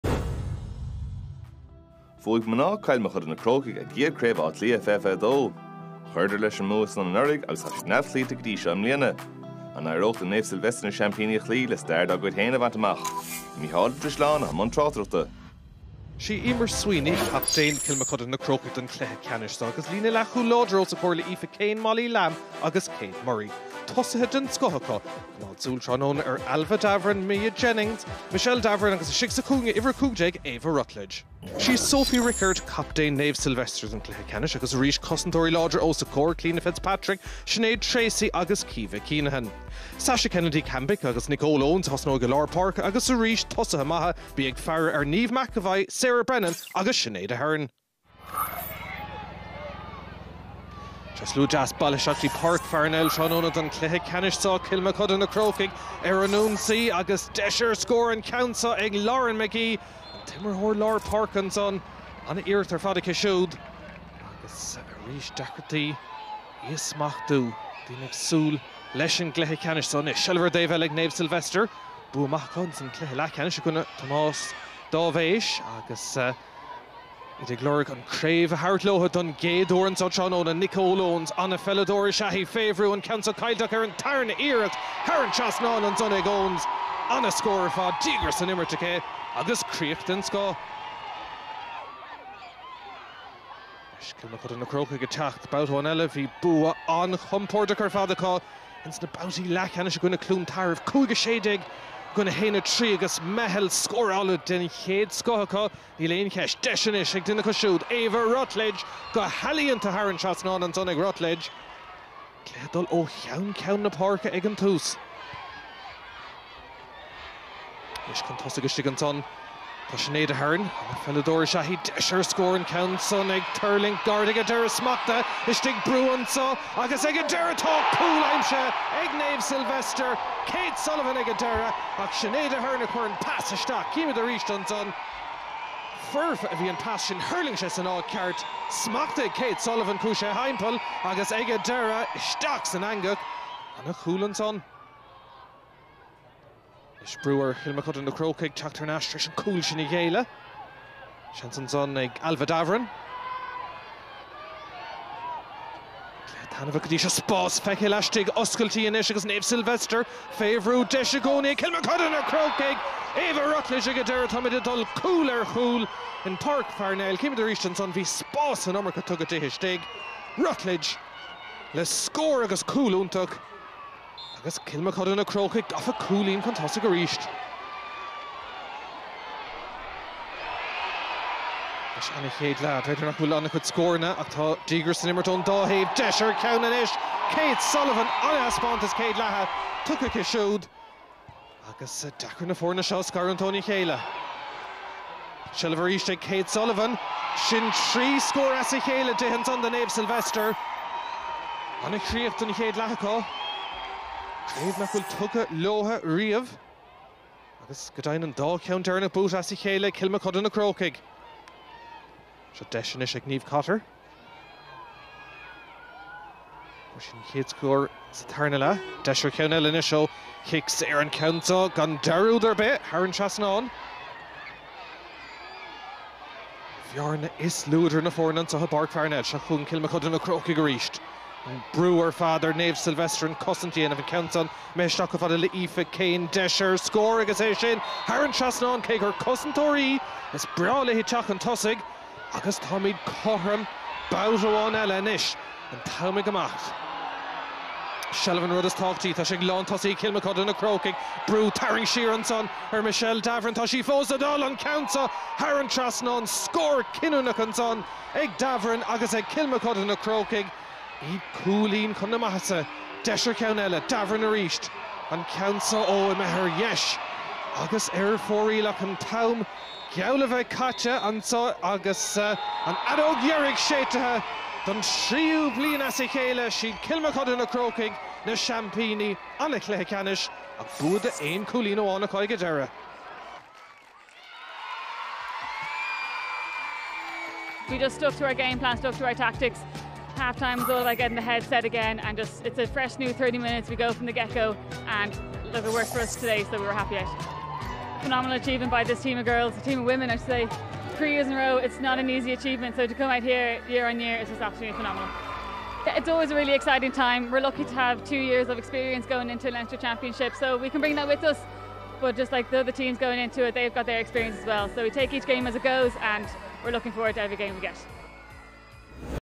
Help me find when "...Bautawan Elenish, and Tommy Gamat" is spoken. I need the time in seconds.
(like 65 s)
244 s.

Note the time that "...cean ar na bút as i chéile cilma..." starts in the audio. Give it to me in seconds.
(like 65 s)
208 s.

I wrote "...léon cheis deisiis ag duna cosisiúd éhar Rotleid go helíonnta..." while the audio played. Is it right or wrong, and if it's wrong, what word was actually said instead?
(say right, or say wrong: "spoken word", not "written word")
right.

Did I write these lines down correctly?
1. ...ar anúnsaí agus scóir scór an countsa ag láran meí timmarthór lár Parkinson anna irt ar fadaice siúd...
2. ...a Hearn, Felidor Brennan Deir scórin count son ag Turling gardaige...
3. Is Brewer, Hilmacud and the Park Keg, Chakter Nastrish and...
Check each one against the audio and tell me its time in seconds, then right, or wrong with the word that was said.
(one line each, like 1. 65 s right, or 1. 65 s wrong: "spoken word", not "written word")
1. 56 s wrong: "deisir", not "scóir"
2. 120 s wrong: "Shahid", not "Brennan"
3. 147 s wrong: "Crow", not "Park".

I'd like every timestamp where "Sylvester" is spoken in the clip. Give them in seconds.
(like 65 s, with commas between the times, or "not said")
33 s, 71 s, 129 s, 159 s, 199 s, 232 s.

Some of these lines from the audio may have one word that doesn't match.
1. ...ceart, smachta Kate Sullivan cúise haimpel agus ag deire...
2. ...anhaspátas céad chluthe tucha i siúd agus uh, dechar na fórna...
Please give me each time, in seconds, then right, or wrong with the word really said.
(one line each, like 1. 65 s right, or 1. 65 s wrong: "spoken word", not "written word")
1. 138 s right
2. 188 s wrong: "lethe", not "chluthe".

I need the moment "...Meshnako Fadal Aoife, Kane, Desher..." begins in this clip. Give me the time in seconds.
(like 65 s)
234 s.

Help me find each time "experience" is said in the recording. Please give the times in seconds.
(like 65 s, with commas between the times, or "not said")
308 s, 313 s.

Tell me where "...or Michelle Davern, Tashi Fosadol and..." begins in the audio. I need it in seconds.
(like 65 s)
252 s.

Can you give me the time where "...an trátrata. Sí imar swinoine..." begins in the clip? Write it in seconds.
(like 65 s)
14 s.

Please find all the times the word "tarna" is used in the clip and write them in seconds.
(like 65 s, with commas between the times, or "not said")
83 s, 218 s.